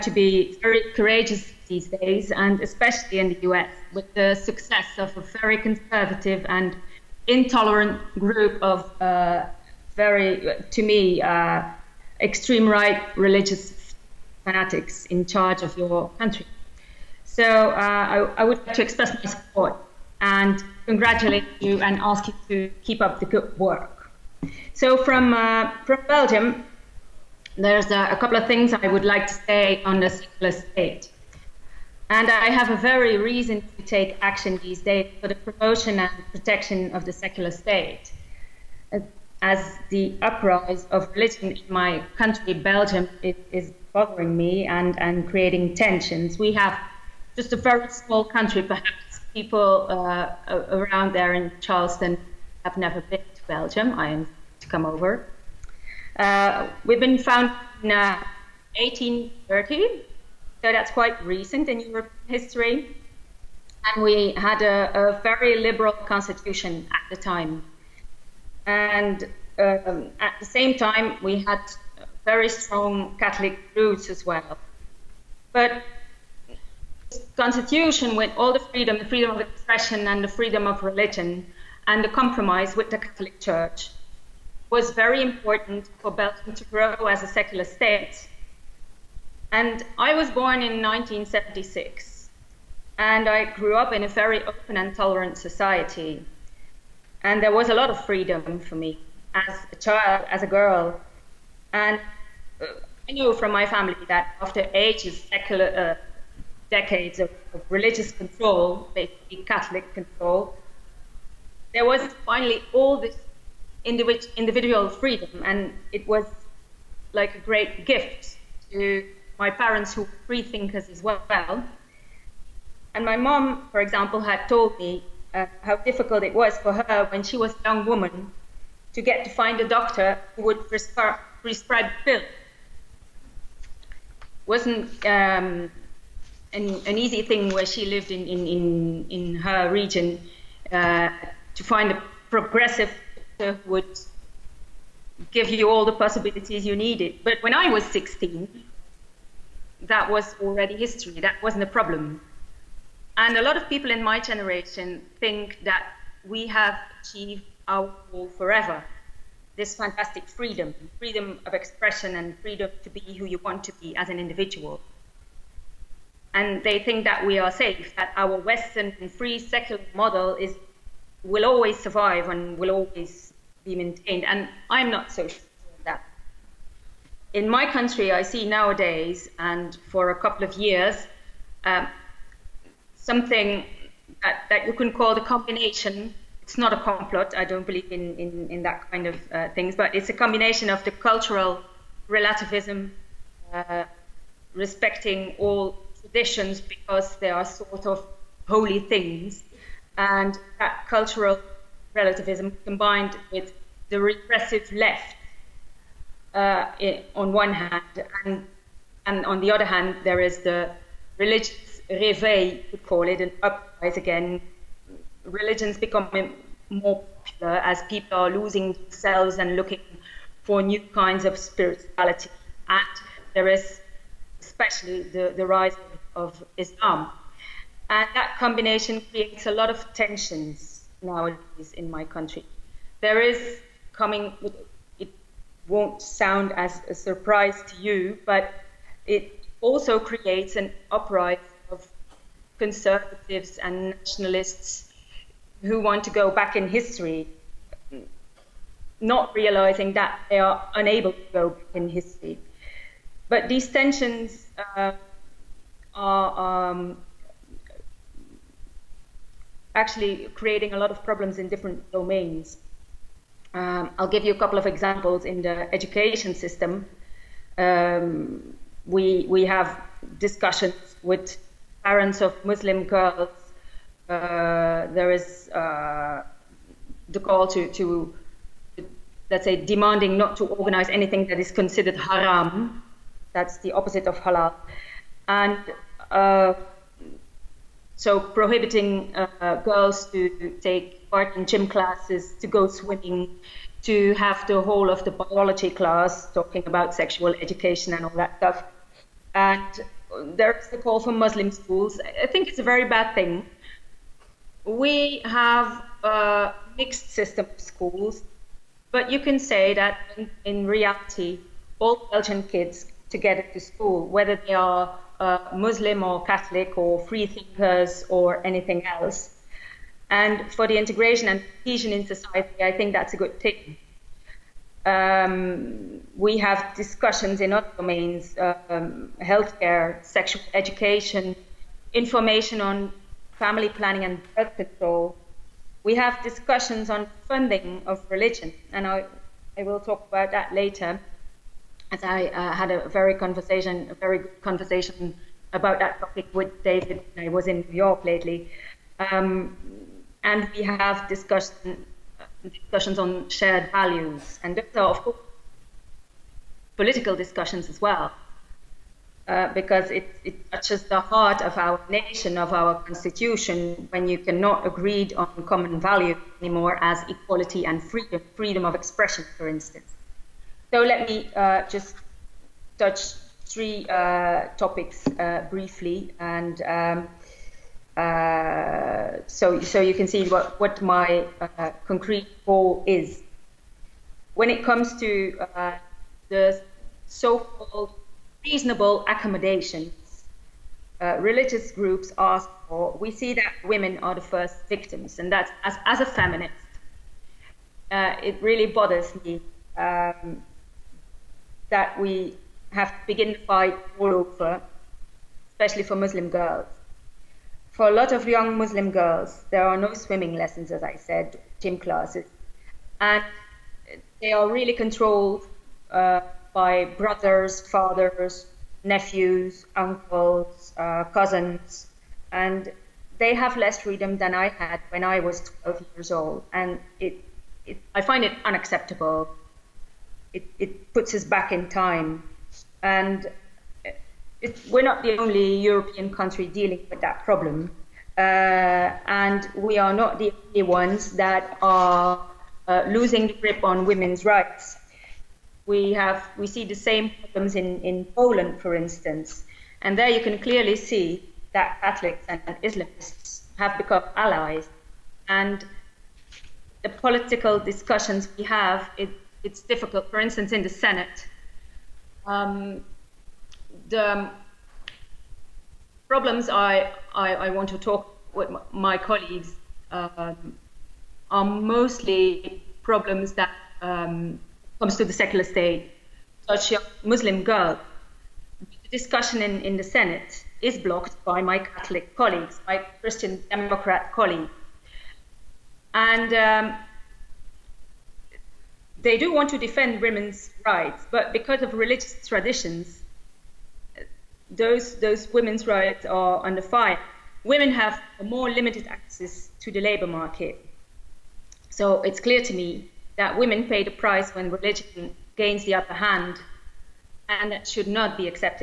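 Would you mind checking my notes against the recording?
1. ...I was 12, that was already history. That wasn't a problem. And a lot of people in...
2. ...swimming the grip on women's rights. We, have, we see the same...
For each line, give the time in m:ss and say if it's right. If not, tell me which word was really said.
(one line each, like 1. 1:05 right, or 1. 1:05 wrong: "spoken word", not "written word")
1. 2:27 wrong: "16", not "12"
2. 7:22 wrong: "losing", not "swimming".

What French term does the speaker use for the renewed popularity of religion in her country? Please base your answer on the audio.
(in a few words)
réveil.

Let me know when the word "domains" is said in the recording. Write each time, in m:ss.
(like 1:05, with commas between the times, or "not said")
4:21, 5:27.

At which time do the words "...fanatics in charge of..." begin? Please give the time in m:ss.
0:14.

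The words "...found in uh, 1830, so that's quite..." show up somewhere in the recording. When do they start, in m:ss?
0:57.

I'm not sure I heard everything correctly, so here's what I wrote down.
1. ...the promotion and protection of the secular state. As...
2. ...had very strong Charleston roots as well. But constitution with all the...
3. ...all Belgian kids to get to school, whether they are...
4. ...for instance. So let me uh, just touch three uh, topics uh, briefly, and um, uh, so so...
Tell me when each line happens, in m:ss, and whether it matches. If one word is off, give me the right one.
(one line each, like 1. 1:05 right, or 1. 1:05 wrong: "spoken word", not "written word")
1. 0:35 right
2. 1:11 wrong: "Catholic", not "Charleston"
3. 5:11 right
4. 6:09 right.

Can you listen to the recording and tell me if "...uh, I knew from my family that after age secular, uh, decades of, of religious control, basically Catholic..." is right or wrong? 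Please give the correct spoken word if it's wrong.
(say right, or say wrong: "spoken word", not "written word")
right.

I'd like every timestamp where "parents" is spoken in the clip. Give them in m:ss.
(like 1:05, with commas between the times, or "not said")
1:59, 4:31.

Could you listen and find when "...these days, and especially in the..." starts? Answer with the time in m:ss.
0:01.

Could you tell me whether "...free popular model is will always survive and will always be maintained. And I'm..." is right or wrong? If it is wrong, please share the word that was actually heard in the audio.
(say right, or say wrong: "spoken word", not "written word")
wrong: "secular", not "popular".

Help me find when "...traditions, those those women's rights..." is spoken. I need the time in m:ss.
8:12.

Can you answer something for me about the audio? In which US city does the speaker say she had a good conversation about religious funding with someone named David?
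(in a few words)
New York.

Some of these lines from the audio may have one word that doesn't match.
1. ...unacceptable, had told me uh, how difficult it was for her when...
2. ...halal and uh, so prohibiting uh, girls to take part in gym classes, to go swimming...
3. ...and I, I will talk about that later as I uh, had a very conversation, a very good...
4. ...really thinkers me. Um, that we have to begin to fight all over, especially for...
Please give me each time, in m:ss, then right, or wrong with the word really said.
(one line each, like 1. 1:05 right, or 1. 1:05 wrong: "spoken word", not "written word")
1. 2:03 wrong: "example", not "unacceptable"
2. 4:44 right
3. 5:38 right
4. 6:38 wrong: "bothers", not "thinkers".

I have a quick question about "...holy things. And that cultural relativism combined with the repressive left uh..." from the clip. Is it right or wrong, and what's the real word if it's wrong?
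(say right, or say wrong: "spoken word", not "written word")
right.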